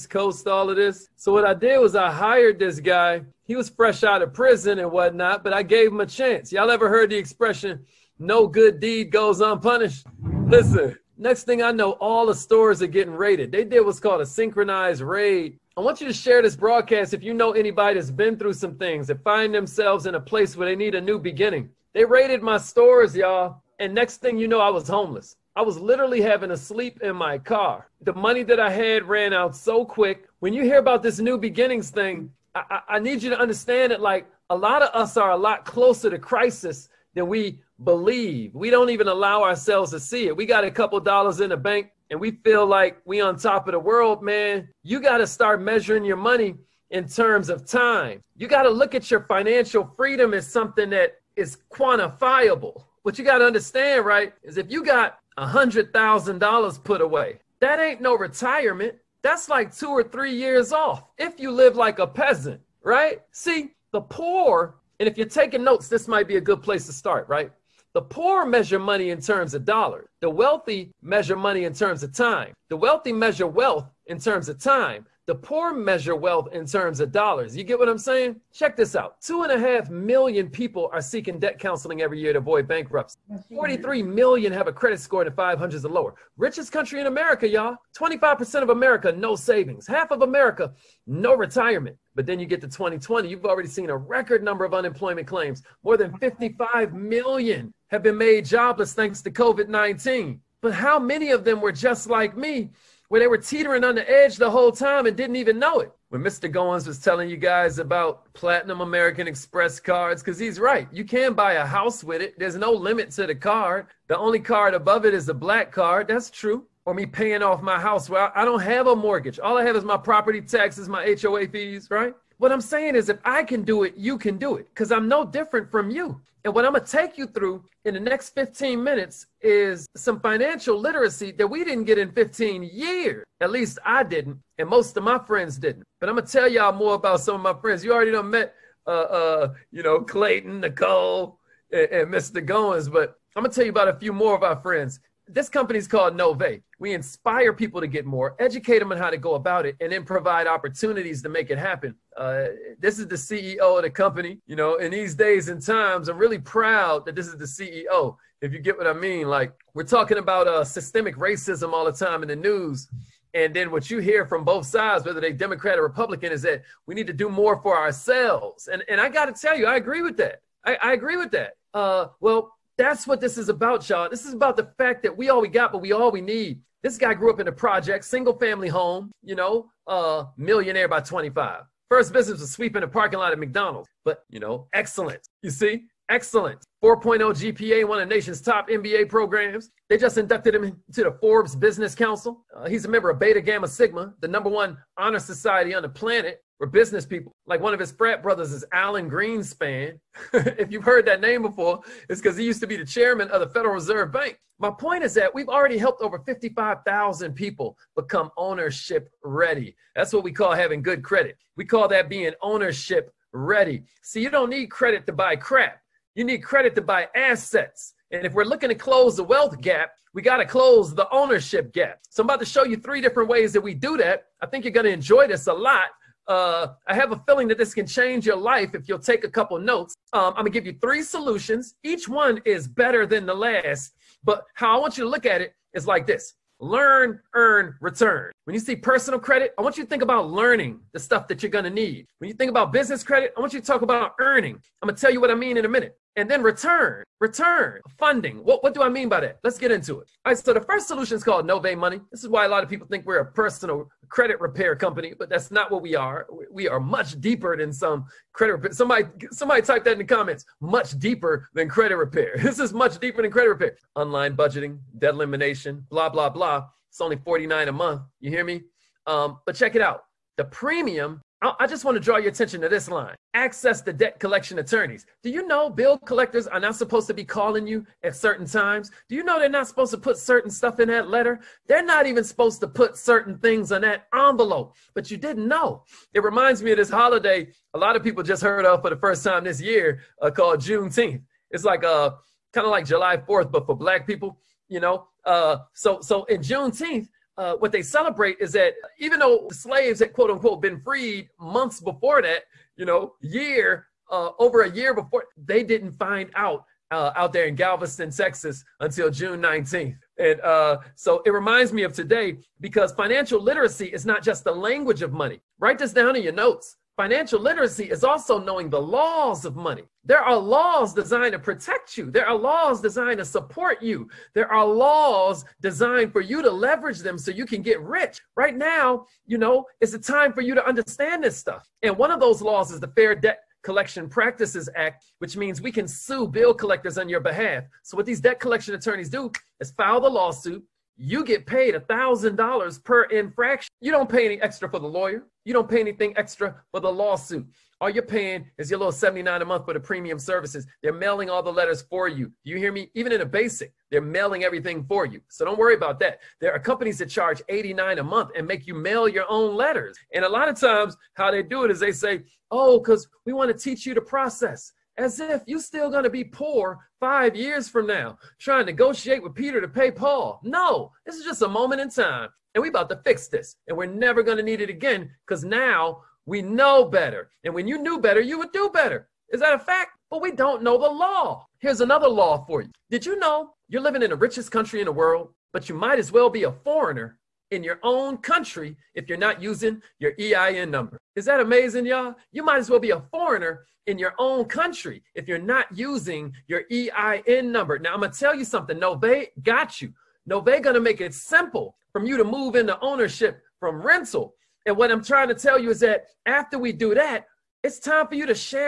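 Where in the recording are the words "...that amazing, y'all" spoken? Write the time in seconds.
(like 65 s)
391 s.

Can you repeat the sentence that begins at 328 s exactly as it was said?
Right now, you know, it's a time for you to understand this stuff.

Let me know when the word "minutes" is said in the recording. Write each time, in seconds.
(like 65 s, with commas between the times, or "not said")
128 s, 245 s.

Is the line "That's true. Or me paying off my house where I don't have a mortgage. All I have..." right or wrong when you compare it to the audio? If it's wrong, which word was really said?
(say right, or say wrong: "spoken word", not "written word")
right.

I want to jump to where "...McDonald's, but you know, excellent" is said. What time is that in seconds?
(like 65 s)
183 s.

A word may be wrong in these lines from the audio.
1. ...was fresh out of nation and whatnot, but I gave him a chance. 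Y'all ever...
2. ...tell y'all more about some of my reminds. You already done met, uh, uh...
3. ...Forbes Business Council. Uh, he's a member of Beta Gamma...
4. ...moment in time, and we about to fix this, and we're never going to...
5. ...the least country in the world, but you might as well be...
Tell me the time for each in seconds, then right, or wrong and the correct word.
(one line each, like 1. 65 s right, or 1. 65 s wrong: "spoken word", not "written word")
1. 3 s wrong: "prison", not "nation"
2. 136 s wrong: "friends", not "reminds"
3. 191 s right
4. 371 s right
5. 384 s wrong: "richest", not "least".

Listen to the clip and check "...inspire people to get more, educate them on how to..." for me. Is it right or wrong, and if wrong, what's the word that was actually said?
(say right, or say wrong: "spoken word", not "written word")
right.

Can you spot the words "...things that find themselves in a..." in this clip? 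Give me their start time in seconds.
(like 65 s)
18 s.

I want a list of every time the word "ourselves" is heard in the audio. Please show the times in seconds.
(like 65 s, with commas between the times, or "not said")
39 s, 167 s.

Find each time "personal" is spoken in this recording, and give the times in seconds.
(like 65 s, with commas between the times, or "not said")
238 s, 253 s.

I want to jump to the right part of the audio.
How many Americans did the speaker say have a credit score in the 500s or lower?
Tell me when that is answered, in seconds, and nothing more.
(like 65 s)
83 s.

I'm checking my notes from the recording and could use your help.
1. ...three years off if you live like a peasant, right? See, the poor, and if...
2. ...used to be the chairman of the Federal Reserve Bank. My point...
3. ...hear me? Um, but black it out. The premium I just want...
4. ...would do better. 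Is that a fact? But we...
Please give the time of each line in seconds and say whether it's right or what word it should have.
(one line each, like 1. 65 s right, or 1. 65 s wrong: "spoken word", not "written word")
1. 60 s right
2. 202 s right
3. 268 s wrong: "check", not "black"
4. 378 s right.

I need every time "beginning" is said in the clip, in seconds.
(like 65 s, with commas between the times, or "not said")
21 s, 31 s.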